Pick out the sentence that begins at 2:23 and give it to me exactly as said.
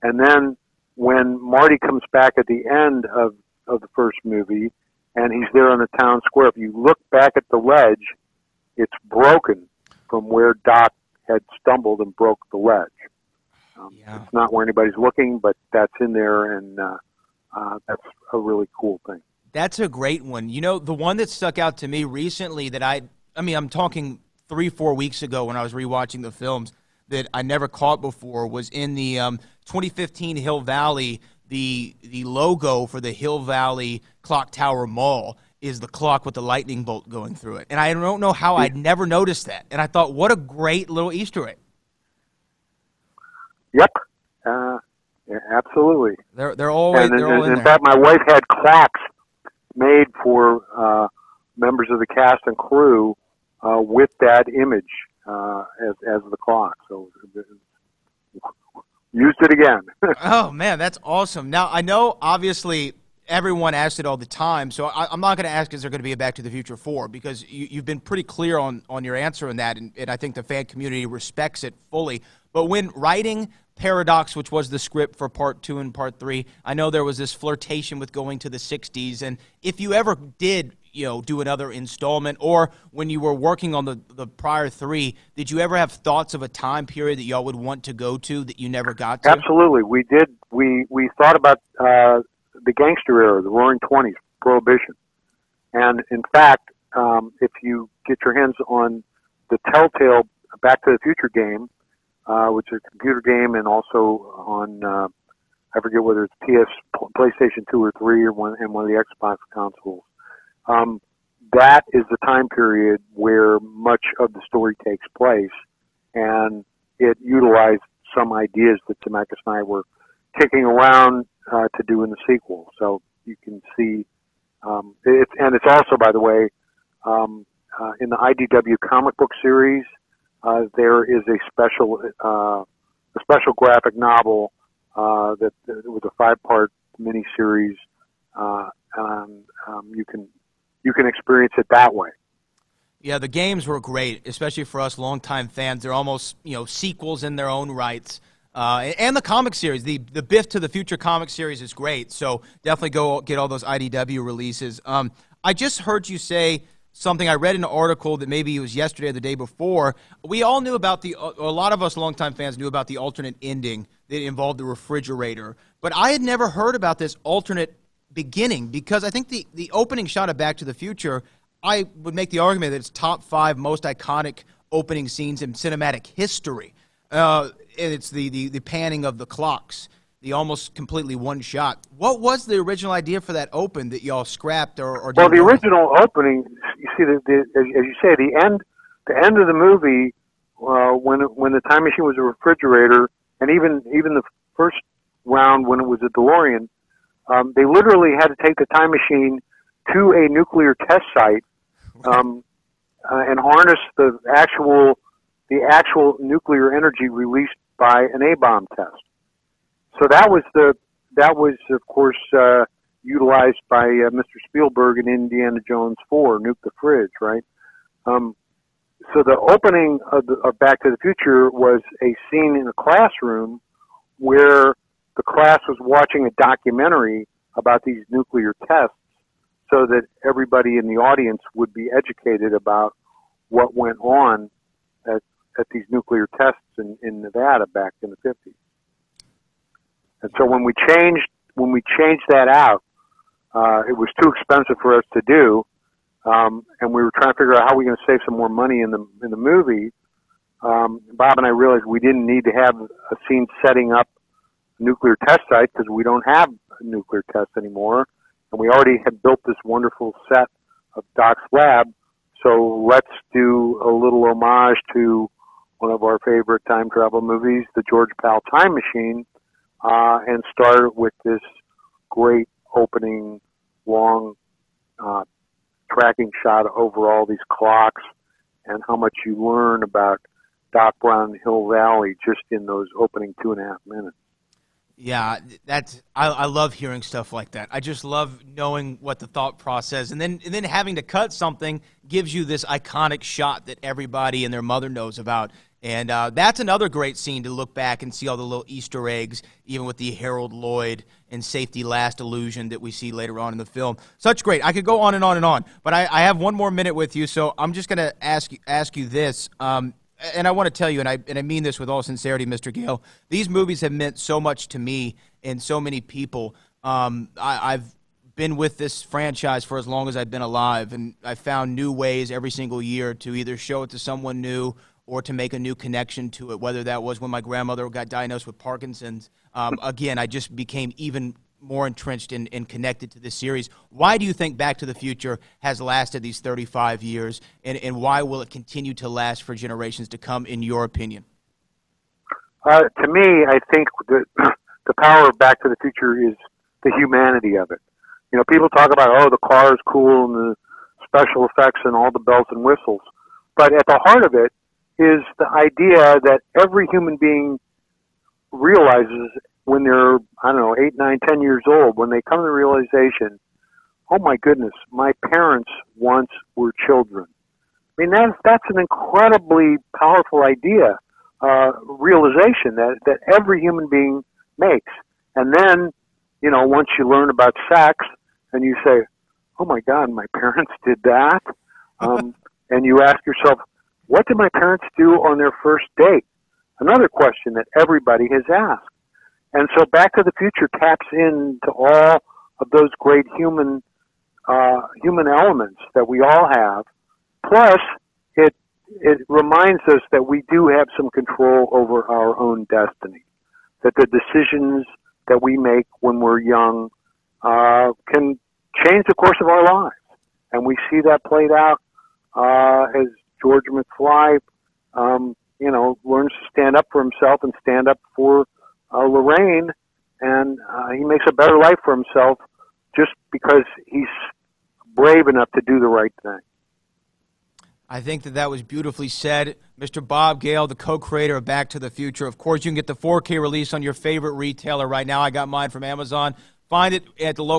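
Yeah, the games were great, especially for us longtime fans.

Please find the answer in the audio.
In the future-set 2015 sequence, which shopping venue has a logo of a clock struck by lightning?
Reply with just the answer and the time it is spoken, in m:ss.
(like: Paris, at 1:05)
Hill Valley Clock Tower Mall, at 0:33.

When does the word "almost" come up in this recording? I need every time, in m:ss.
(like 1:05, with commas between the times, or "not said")
2:25, 3:00.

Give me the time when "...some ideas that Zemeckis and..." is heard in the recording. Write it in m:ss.
1:58.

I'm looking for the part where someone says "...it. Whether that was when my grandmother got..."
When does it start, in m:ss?
5:26.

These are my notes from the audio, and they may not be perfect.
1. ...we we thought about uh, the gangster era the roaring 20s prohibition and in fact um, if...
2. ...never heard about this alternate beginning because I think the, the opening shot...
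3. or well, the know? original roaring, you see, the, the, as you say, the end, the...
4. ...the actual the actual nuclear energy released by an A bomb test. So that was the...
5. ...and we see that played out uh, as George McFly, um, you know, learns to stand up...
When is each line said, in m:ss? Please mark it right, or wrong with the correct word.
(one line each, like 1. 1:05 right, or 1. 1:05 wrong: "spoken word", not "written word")
1. 1:30 right
2. 2:46 right
3. 3:04 wrong: "opening", not "roaring"
4. 3:23 right
5. 6:50 right.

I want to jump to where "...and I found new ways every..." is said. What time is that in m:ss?
5:20.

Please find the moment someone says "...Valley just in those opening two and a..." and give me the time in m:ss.
4:41.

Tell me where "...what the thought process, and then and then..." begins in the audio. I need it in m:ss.
4:49.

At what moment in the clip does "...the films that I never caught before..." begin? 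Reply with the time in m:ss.
0:26.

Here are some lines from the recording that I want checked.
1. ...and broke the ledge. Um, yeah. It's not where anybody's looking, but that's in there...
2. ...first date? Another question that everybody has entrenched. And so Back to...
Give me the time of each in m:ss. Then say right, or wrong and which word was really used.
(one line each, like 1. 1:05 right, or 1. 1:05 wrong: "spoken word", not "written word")
1. 0:12 right
2. 6:25 wrong: "asked", not "entrenched".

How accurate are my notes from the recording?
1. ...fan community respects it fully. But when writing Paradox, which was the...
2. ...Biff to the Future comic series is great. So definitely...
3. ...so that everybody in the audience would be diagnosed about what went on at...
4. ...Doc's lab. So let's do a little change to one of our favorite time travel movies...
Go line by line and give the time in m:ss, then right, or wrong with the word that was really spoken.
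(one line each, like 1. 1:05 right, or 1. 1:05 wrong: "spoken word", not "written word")
1. 1:10 right
2. 2:30 right
3. 3:49 wrong: "educated", not "diagnosed"
4. 4:21 wrong: "homage", not "change".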